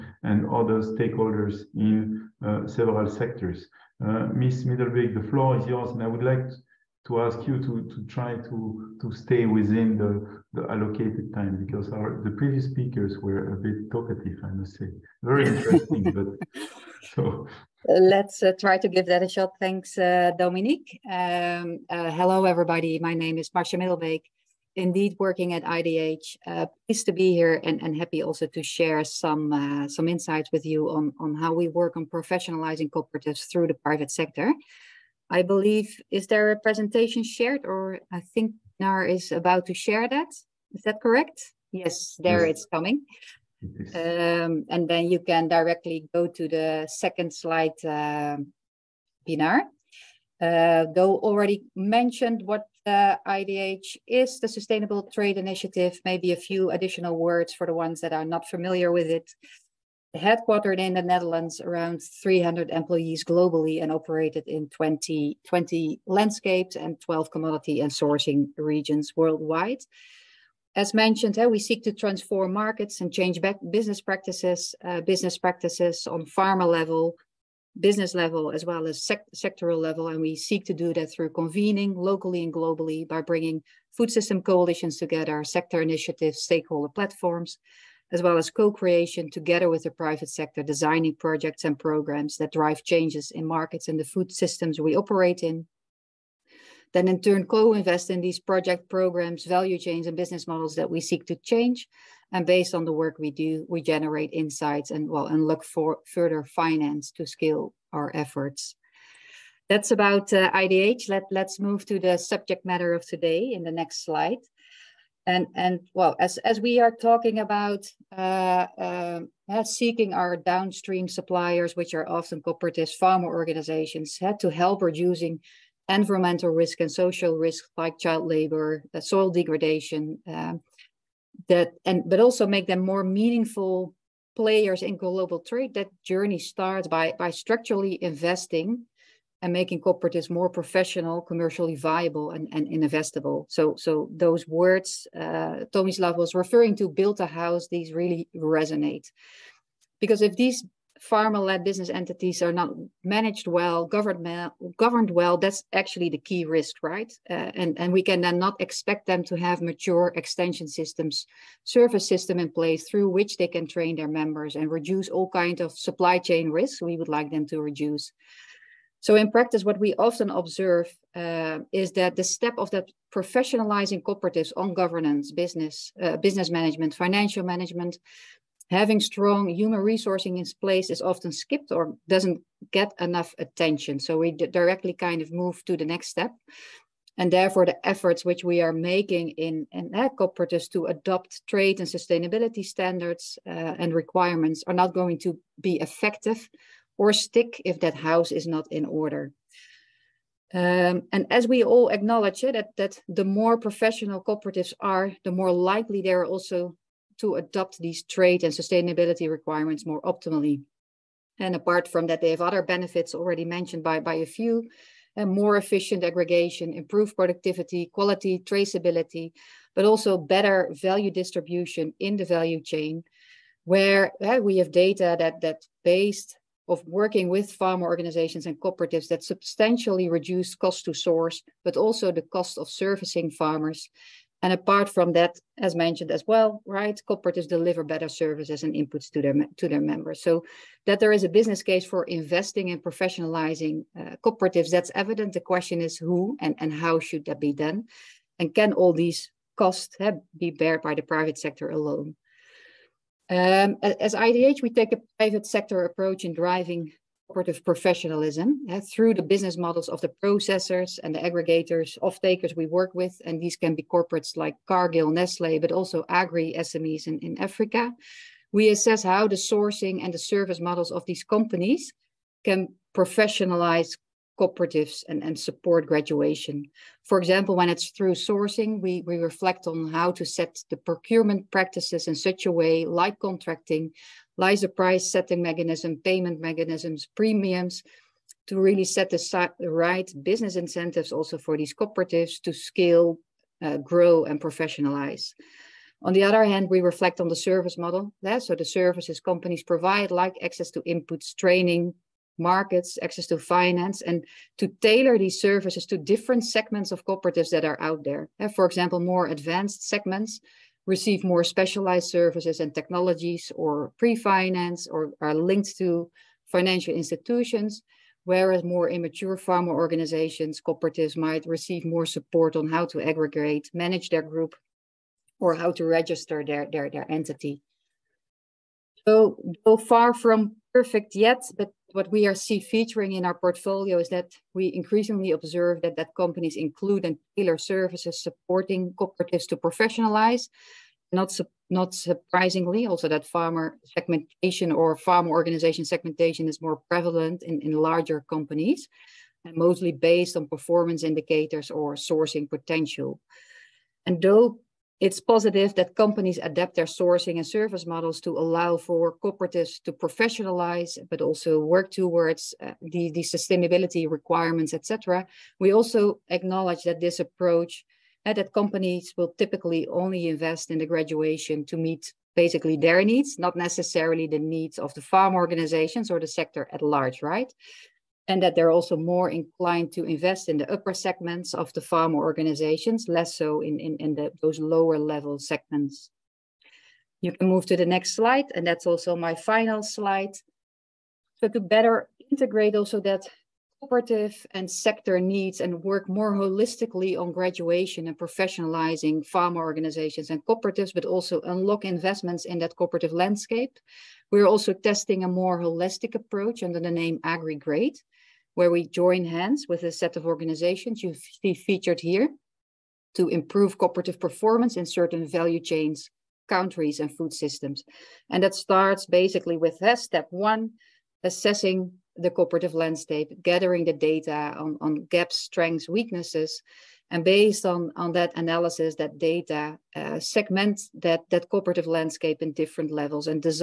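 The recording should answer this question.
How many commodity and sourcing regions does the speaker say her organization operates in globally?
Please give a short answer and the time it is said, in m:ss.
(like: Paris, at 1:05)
12, at 1:07.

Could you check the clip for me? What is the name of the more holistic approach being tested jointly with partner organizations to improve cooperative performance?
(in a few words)
AgriGrade.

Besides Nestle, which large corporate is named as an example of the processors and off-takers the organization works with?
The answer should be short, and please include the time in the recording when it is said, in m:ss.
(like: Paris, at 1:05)
Cargill, at 4:24.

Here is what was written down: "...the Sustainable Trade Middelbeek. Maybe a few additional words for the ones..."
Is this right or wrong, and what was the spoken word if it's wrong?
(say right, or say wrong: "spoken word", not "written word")
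wrong: "Initiative", not "Middelbeek".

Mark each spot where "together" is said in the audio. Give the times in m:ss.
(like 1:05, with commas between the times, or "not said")
1:24, 1:29.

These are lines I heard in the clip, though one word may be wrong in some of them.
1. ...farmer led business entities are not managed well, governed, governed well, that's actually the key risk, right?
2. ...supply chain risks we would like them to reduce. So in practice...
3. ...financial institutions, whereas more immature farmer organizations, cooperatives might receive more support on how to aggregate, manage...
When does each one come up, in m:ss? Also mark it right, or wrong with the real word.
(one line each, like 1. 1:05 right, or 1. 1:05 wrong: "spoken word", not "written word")
1. 2:31 right
2. 2:45 right
3. 5:16 right.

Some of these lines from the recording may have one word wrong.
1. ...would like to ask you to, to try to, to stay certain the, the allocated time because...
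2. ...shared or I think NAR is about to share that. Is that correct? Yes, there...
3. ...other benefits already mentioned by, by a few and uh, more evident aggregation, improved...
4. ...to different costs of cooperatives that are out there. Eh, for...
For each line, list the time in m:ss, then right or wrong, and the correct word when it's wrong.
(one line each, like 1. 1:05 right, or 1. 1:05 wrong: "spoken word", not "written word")
1. 0:06 wrong: "within", not "certain"
2. 0:37 right
3. 3:32 wrong: "efficient", not "evident"
4. 5:05 wrong: "segments", not "costs".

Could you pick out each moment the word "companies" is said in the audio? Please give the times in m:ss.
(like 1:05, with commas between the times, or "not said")
4:31, 4:59, 5:36, 5:48, 5:55, 6:08.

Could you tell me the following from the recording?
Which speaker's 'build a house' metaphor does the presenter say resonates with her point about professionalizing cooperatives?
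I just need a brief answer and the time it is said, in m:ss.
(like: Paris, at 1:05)
Tomislav, at 2:25.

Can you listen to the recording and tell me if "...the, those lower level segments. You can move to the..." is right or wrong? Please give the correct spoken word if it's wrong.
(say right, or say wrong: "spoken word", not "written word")
right.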